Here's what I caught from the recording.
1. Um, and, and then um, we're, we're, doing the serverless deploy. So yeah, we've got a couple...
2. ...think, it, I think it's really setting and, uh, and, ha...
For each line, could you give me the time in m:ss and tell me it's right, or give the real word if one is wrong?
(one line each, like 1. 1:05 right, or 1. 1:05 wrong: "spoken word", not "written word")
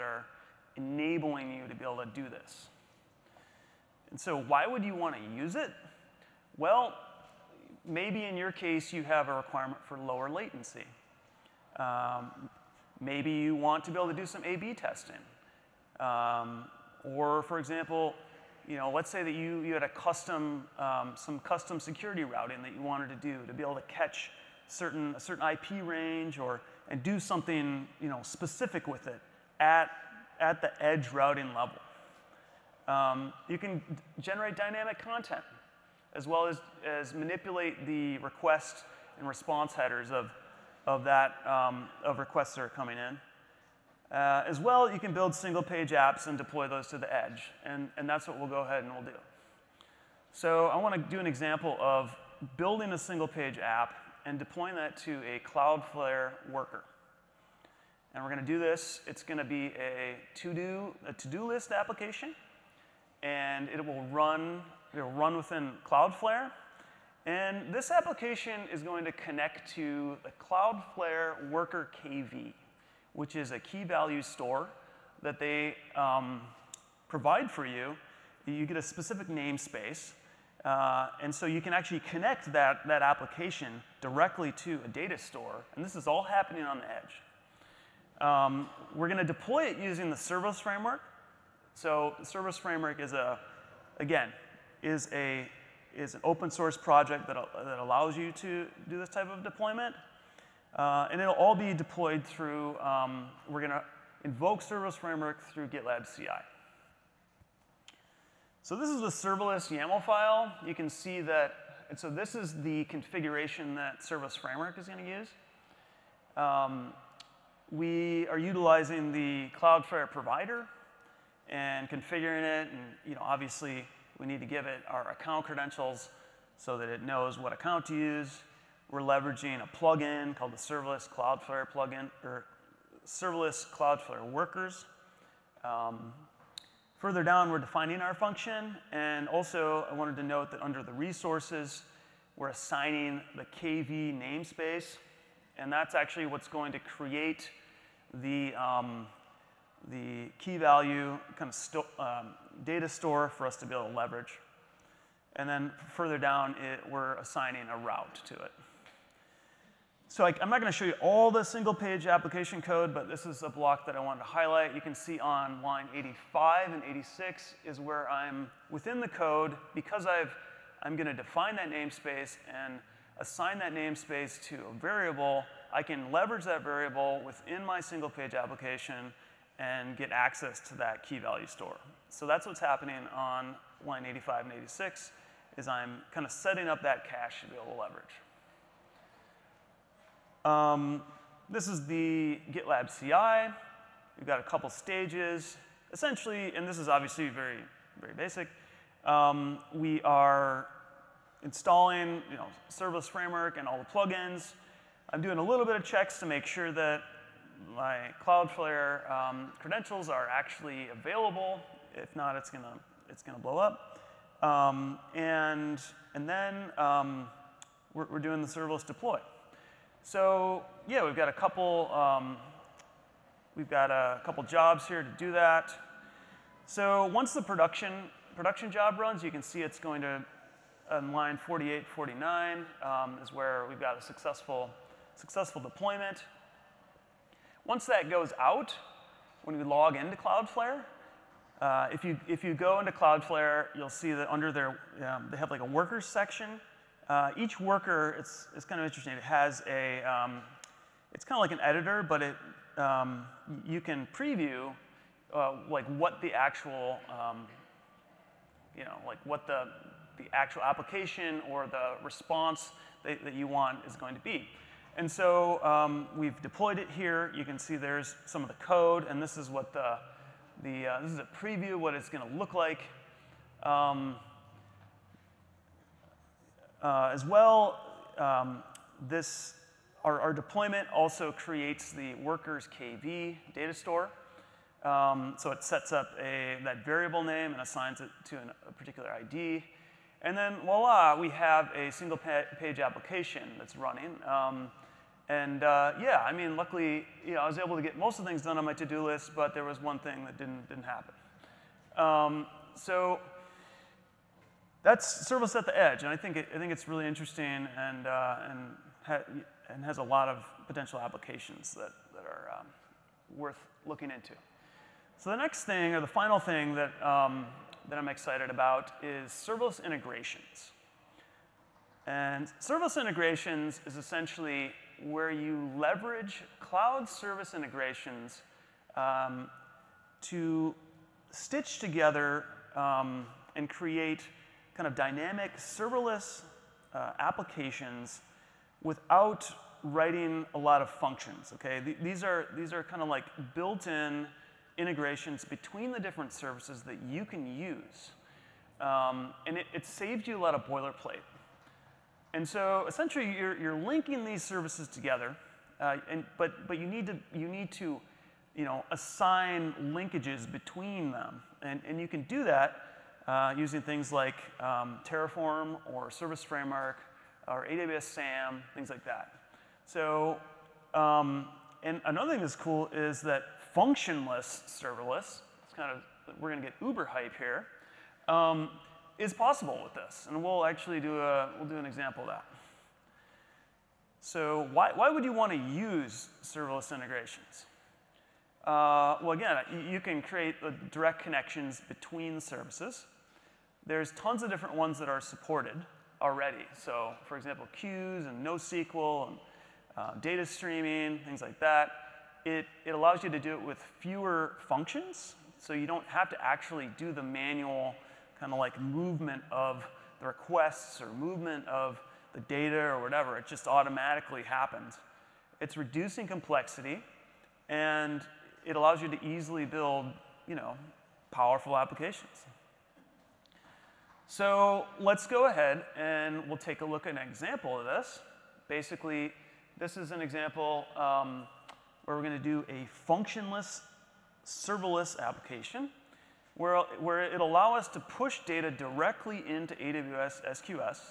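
1. 3:34 right
2. 5:06 wrong: "interesting", not "setting".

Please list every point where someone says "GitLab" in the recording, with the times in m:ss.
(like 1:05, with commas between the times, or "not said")
1:45, 3:12.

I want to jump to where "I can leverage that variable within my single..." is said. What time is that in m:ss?
2:55.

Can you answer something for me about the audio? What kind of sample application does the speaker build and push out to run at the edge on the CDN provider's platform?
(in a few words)
to-do list application.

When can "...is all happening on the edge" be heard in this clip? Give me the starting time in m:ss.
1:25.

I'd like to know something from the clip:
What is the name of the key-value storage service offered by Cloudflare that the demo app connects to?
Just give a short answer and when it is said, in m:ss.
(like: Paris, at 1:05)
Cloudflare Worker KV, at 1:10.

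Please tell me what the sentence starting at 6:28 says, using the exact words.
Uh, well, again, you can create direct connections between services.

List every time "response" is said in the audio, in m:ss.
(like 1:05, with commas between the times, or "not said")
0:39, 4:22.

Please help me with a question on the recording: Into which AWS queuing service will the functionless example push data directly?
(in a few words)
AWS SQS.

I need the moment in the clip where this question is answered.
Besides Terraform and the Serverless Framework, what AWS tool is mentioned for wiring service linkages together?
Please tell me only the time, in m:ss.
6:07.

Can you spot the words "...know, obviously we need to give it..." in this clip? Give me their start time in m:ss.
2:03.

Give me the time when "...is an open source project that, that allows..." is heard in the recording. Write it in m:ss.
1:35.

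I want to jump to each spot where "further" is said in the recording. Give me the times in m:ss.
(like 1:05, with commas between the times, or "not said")
2:16, 2:35.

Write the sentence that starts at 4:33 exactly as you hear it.
Um, uh, as well, um, this, our, our, deployment also creates the workers KV data store.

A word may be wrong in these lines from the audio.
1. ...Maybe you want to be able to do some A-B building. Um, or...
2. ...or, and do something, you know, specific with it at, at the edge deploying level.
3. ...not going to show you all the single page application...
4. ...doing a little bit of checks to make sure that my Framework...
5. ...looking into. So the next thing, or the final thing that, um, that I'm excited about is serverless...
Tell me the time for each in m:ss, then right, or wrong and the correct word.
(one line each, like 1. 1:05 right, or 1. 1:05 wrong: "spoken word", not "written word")
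1. 0:13 wrong: "testing", not "building"
2. 0:26 wrong: "routing", not "deploying"
3. 2:40 right
4. 3:25 wrong: "Cloudflare", not "Framework"
5. 5:13 right.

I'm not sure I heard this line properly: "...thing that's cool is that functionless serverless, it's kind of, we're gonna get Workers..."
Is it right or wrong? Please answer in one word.
wrong.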